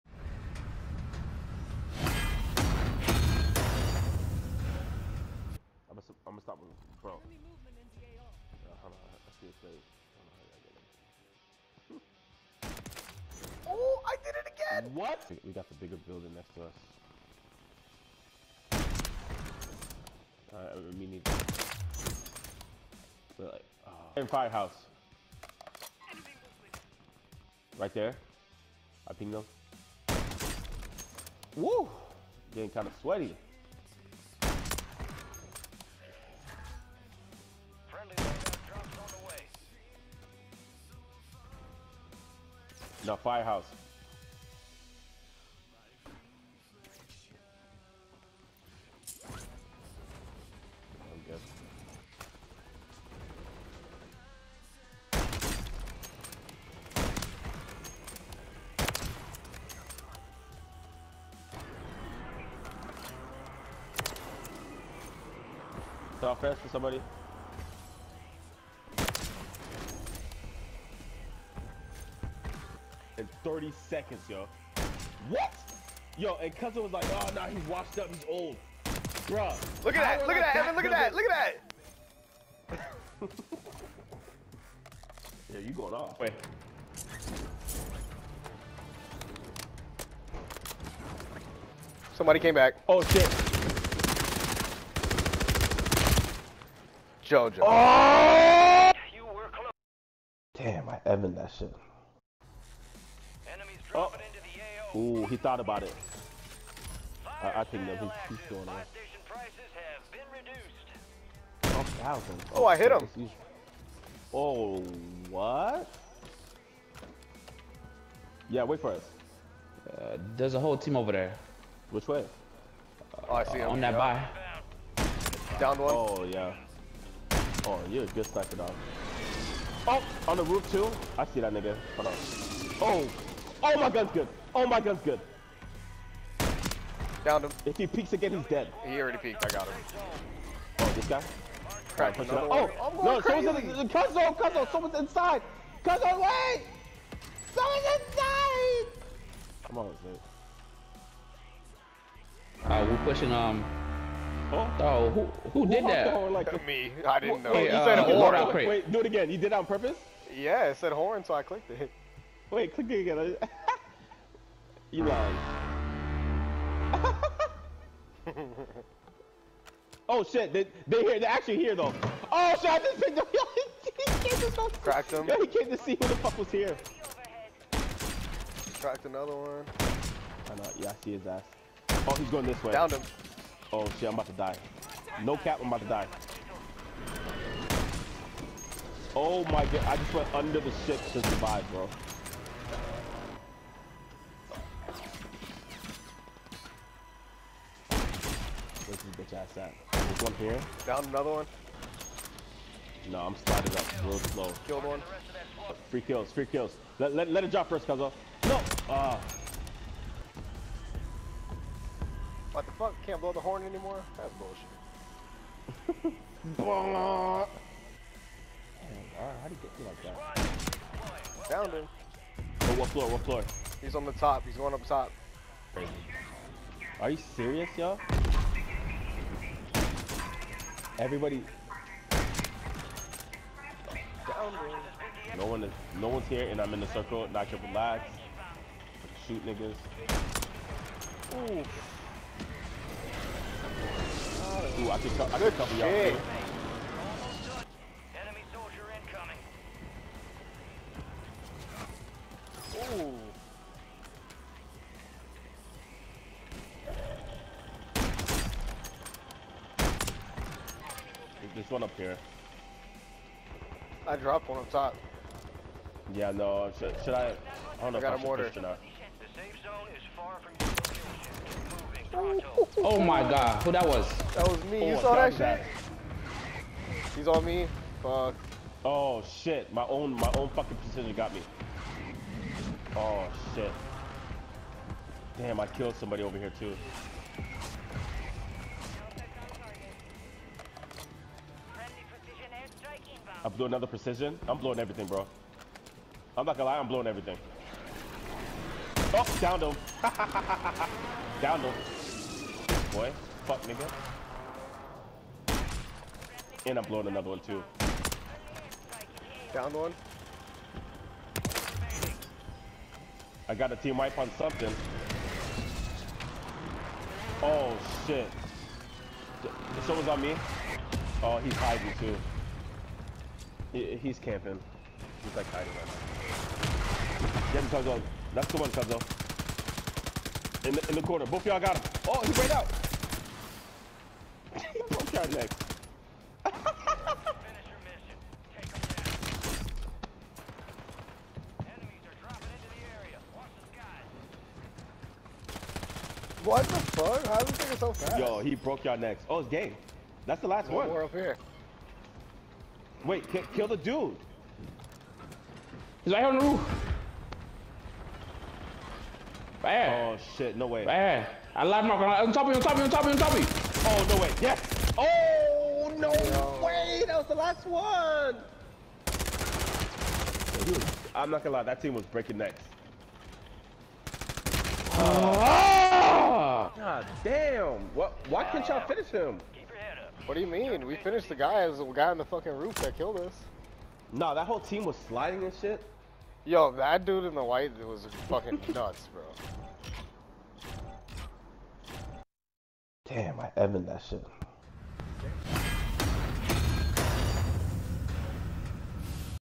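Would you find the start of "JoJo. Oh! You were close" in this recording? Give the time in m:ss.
1:37.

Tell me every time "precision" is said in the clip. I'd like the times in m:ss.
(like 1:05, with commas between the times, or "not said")
4:40, 4:53.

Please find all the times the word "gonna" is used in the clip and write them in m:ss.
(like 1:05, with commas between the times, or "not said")
4:56, 6:11.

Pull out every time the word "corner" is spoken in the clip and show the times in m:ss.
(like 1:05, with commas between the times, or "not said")
5:31.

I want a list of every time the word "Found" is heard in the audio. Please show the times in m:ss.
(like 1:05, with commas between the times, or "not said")
3:41.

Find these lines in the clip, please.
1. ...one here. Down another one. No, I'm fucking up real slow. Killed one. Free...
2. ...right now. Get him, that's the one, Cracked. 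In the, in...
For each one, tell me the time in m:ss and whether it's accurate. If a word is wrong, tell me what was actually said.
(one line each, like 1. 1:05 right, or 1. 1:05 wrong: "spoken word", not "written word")
1. 3:20 wrong: "sliding", not "fucking"
2. 5:25 wrong: "Cuzzo", not "Cracked".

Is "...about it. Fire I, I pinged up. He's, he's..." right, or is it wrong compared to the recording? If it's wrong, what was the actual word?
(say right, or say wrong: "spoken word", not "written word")
wrong: "picked", not "pinged".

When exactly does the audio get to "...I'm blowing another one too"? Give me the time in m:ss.
5:06.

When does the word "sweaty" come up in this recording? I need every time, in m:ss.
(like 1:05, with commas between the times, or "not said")
0:33.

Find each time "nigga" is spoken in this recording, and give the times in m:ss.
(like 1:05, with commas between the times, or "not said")
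2:11, 3:59, 5:03.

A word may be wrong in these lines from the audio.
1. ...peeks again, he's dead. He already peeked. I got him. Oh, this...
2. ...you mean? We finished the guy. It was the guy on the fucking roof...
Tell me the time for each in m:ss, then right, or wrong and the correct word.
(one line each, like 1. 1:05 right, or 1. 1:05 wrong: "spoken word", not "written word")
1. 2:17 right
2. 6:20 right.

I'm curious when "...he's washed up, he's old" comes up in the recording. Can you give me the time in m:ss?
1:17.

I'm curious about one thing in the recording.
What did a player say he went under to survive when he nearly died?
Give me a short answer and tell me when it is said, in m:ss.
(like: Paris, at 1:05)
The six, at 3:10.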